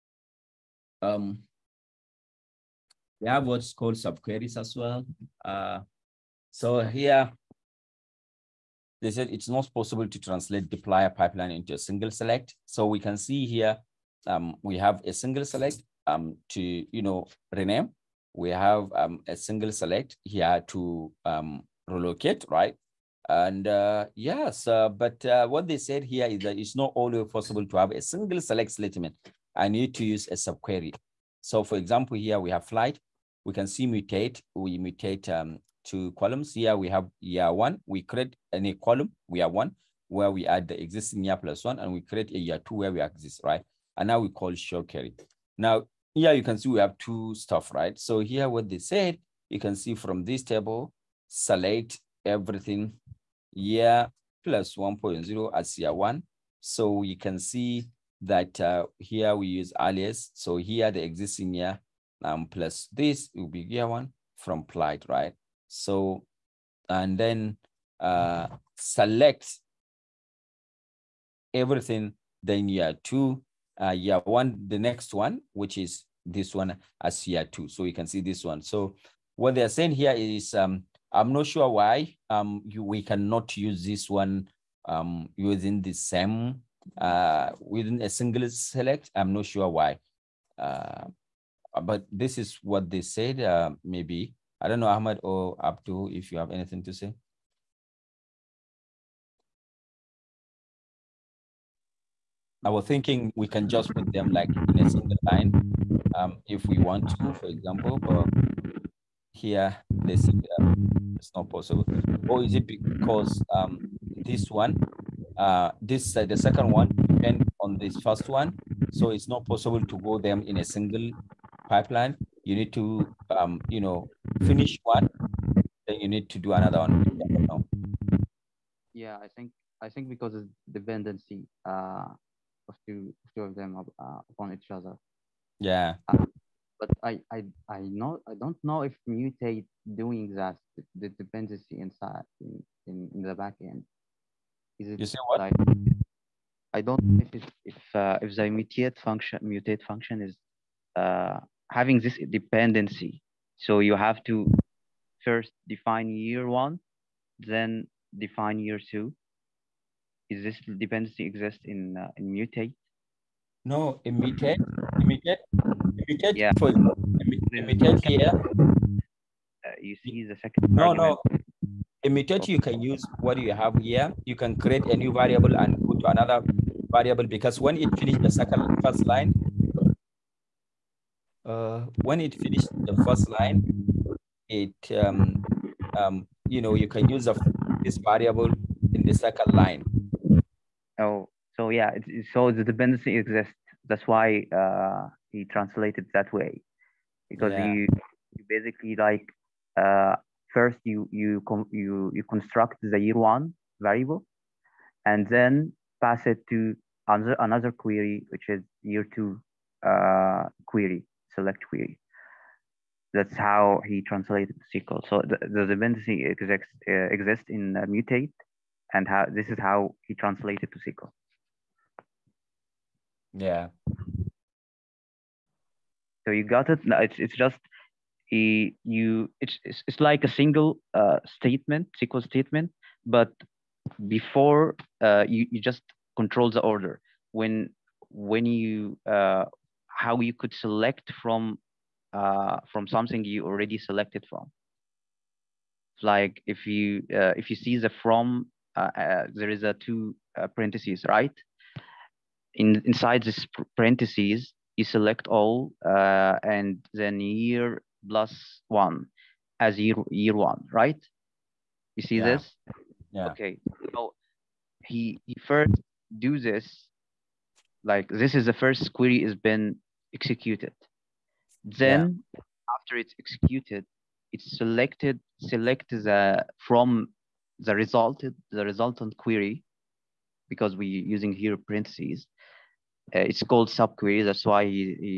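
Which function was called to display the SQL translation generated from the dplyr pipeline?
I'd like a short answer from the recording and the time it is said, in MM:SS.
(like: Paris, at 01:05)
show query, at 00:44.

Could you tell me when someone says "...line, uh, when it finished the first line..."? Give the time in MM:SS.
02:59.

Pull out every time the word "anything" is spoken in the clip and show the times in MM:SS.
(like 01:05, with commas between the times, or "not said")
01:36.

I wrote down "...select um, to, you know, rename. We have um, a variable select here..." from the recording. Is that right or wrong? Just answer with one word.
wrong.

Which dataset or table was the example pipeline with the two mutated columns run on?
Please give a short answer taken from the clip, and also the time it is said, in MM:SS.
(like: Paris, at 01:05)
flight, at 00:32.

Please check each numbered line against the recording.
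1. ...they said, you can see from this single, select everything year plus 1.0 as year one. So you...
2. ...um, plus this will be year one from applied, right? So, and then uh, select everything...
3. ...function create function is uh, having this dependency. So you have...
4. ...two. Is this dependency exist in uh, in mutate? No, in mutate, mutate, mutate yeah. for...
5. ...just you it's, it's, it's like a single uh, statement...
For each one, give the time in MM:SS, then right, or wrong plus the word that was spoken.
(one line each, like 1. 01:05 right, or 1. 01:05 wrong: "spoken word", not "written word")
1. 00:48 wrong: "table", not "single"
2. 01:02 right
3. 02:28 wrong: "mutate", not "create"
4. 02:38 right
5. 03:47 right.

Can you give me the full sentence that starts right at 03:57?
When when you uh, how you could select from uh, from something you already selected from.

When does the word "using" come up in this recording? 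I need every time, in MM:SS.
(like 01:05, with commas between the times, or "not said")
01:25, 04:40.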